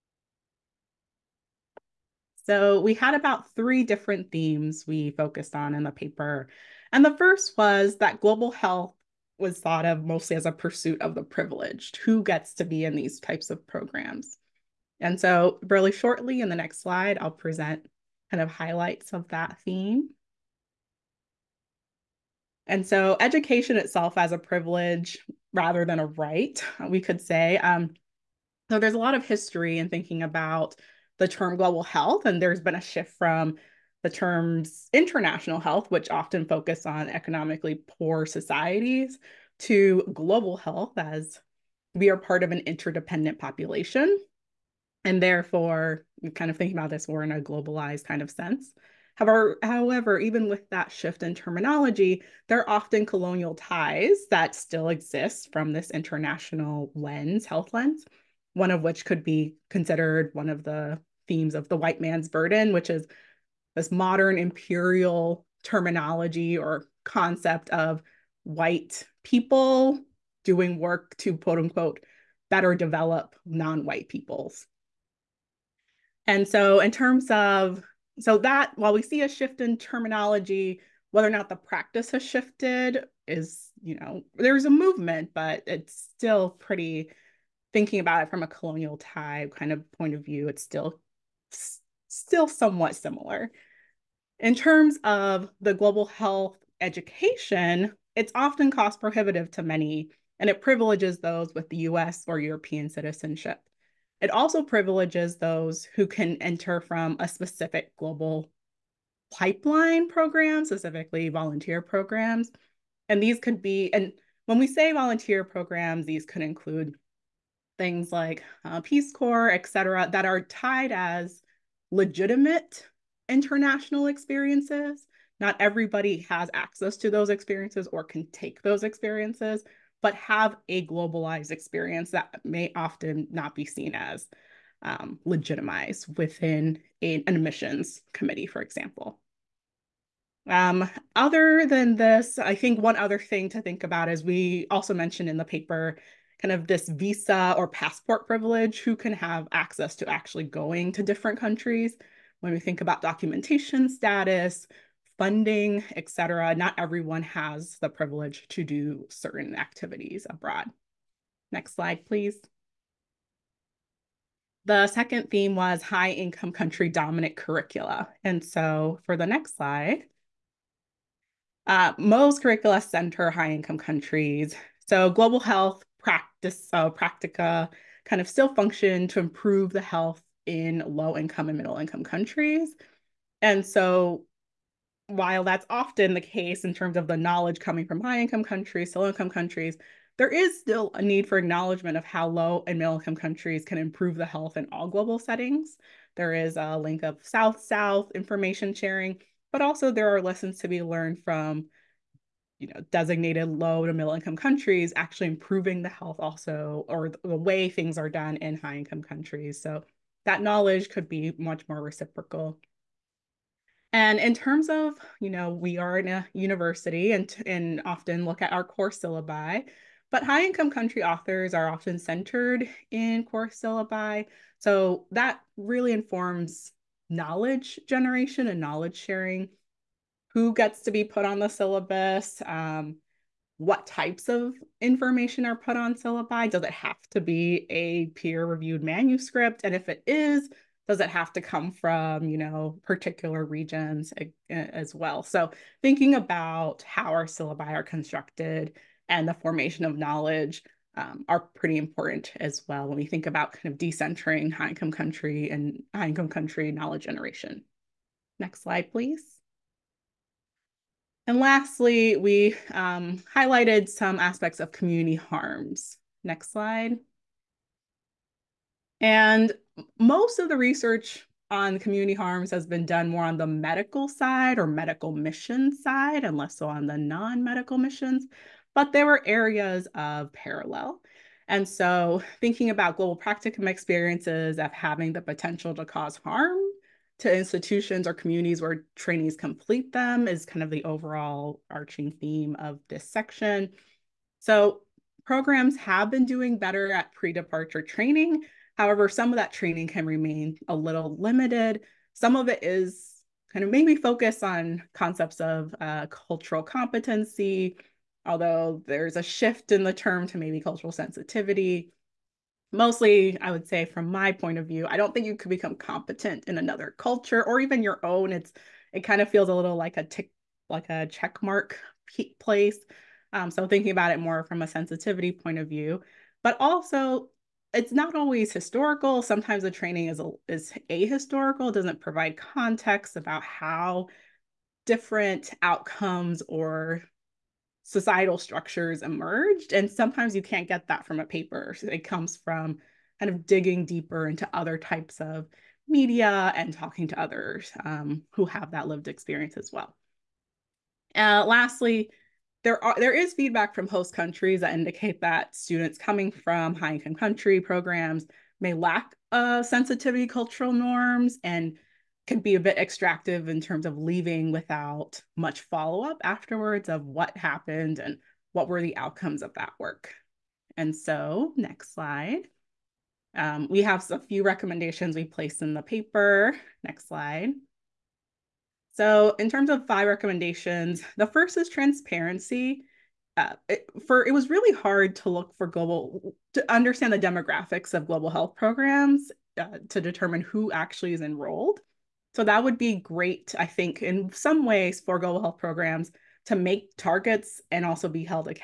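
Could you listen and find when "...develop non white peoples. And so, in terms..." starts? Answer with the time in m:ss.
1:12.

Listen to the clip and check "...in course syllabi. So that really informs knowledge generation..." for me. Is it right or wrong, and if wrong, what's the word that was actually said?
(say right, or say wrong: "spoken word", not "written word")
right.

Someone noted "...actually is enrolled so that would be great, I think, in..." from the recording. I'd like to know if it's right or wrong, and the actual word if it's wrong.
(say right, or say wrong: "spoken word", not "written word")
right.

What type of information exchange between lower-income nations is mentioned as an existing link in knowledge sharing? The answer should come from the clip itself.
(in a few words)
South South information sharing.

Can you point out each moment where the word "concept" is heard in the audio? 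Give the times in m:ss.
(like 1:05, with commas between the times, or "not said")
1:07, 5:04.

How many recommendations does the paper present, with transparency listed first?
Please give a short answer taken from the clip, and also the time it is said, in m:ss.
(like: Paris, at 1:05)
5, at 6:19.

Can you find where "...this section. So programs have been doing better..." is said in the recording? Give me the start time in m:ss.
4:52.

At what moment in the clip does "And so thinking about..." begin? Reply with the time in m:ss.
4:41.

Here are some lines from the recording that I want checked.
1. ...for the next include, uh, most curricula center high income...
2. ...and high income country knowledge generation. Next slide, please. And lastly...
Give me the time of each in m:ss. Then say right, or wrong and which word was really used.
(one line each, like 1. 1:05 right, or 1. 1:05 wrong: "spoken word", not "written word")
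1. 2:49 wrong: "slide", not "include"
2. 4:15 right.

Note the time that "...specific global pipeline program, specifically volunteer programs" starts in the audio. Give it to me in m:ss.
1:47.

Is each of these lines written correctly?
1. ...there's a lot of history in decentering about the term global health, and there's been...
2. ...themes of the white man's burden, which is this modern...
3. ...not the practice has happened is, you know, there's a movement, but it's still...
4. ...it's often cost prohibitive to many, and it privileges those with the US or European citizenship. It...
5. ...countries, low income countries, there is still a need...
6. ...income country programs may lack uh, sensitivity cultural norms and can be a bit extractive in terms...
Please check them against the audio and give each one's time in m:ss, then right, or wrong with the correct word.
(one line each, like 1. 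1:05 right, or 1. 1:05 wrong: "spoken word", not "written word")
1. 0:28 wrong: "thinking", not "decentering"
2. 1:01 right
3. 1:21 wrong: "shifted", not "happened"
4. 1:38 right
5. 3:08 right
6. 5:56 right.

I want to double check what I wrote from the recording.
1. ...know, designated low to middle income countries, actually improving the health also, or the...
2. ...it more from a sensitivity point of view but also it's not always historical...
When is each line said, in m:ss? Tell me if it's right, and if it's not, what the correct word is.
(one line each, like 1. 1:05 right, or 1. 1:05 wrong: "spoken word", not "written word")
1. 3:22 right
2. 5:24 right.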